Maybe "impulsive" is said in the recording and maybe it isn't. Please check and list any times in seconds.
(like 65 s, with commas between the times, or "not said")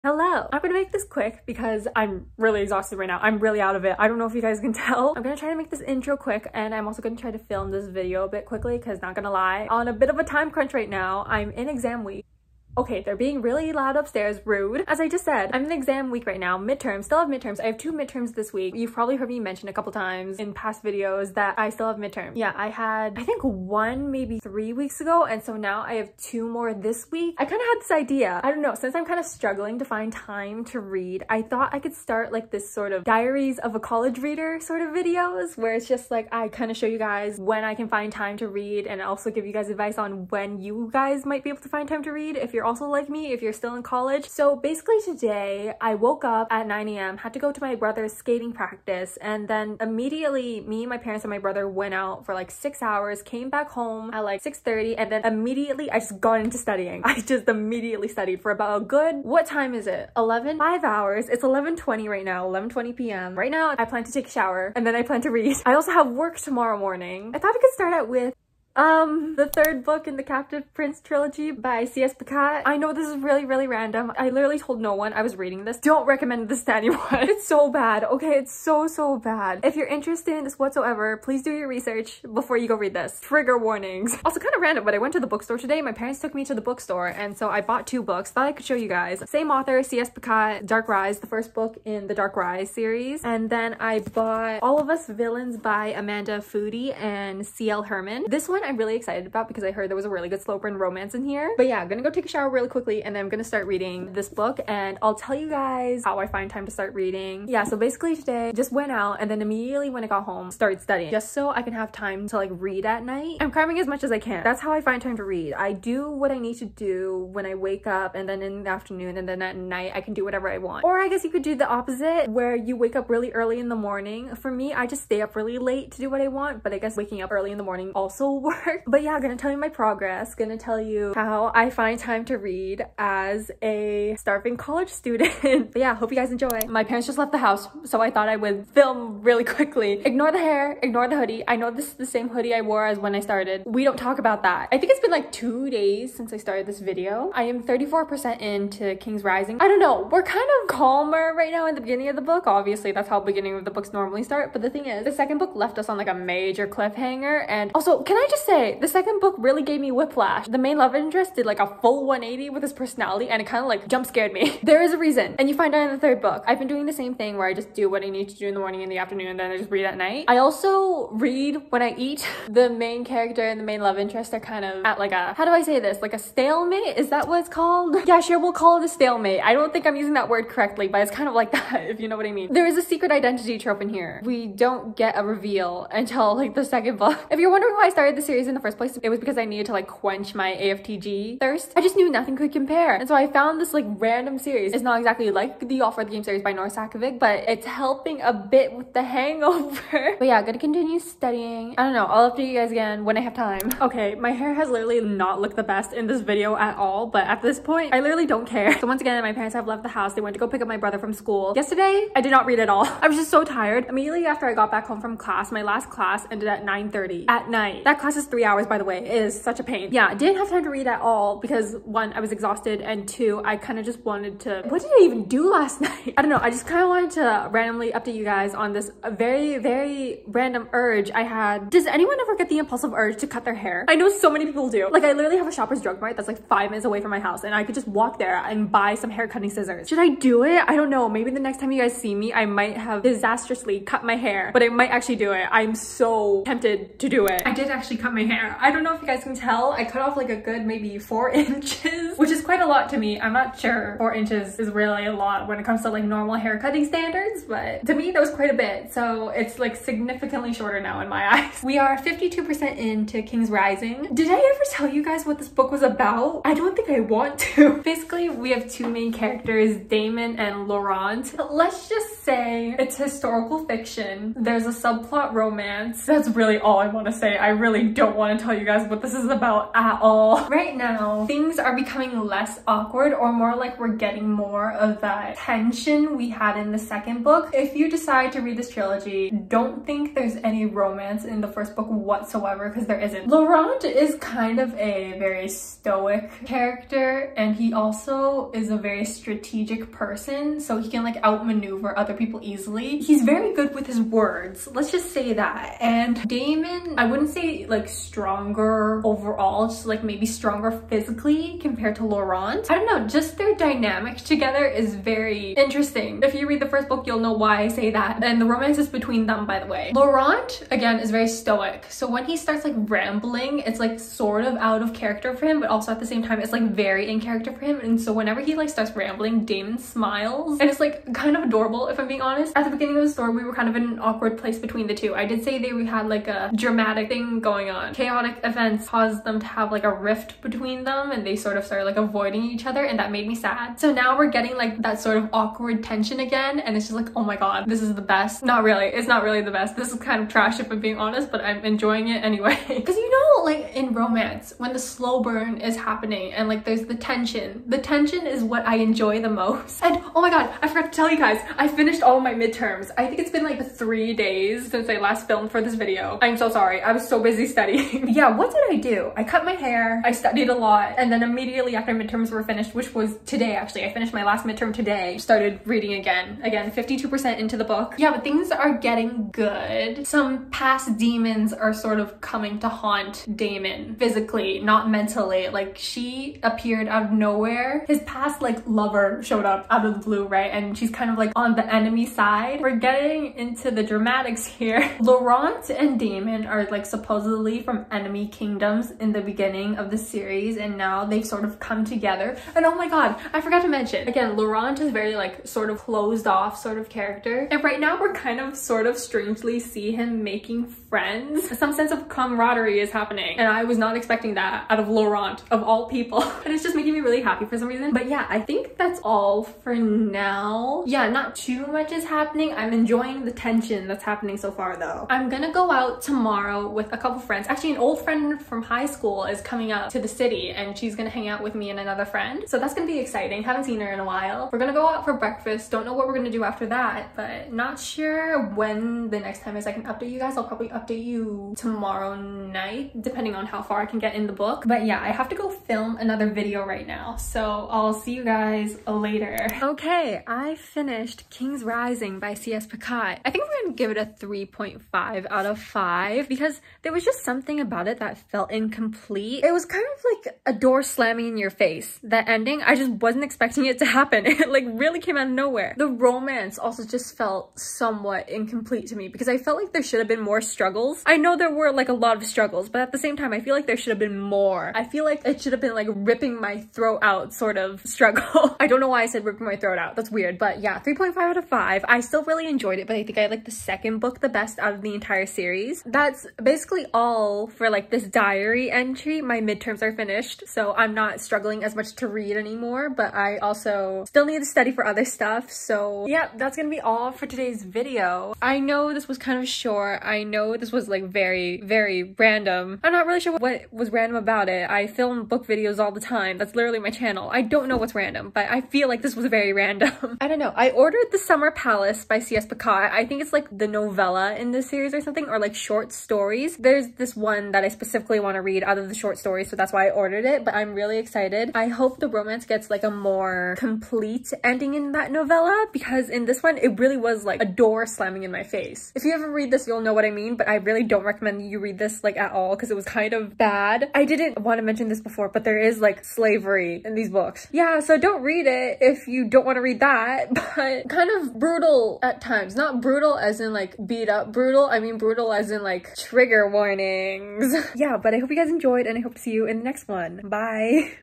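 232 s.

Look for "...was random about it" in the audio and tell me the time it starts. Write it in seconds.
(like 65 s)
503 s.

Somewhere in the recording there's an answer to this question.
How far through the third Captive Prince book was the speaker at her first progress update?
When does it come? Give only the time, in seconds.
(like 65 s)
147 s.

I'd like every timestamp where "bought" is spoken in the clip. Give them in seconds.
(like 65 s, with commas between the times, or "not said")
87 s, 93 s.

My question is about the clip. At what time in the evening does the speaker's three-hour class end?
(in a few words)
9.30.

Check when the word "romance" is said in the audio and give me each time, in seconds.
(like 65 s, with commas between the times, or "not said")
100 s, 275 s, 290 s, 318 s, 353 s, 466 s, 522 s.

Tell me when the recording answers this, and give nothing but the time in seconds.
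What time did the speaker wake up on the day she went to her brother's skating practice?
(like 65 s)
46 s.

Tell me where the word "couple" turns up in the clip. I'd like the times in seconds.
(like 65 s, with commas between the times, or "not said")
19 s, 426 s.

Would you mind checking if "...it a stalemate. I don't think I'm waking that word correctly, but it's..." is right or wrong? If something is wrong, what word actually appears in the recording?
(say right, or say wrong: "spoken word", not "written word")
wrong: "using", not "waking".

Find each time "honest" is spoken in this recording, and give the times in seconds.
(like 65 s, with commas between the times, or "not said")
332 s, 350 s.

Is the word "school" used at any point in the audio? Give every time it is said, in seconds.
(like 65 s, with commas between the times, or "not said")
211 s, 428 s.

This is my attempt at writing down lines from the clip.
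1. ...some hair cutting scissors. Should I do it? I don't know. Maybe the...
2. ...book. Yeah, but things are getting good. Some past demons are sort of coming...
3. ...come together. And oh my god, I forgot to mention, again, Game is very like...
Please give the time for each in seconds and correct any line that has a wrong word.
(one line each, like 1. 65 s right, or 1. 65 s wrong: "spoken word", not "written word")
1. 238 s right
2. 377 s right
3. 401 s wrong: "Laurent", not "Game".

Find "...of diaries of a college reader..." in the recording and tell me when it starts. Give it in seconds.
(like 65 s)
32 s.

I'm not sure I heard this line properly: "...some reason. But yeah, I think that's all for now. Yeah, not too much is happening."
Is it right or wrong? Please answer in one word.
right.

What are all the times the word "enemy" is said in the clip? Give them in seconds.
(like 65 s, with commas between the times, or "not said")
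391 s, 397 s.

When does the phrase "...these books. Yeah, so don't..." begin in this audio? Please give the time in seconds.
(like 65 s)
536 s.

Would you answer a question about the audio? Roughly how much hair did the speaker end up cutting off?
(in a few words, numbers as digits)
4 inches.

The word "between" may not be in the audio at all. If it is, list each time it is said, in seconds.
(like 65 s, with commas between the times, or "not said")
318 s, 334 s, 340 s.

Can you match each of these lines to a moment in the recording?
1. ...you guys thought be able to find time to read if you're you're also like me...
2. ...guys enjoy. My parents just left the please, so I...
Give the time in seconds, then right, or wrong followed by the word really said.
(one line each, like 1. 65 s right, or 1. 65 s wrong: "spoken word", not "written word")
1. 40 s wrong: "might", not "thought"
2. 136 s wrong: "house", not "please".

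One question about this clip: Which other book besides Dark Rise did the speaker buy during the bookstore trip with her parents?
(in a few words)
All of Us Villains.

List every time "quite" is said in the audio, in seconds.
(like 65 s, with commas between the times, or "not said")
252 s, 258 s.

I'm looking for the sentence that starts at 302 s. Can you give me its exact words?
He's very good with his words, let's just say that.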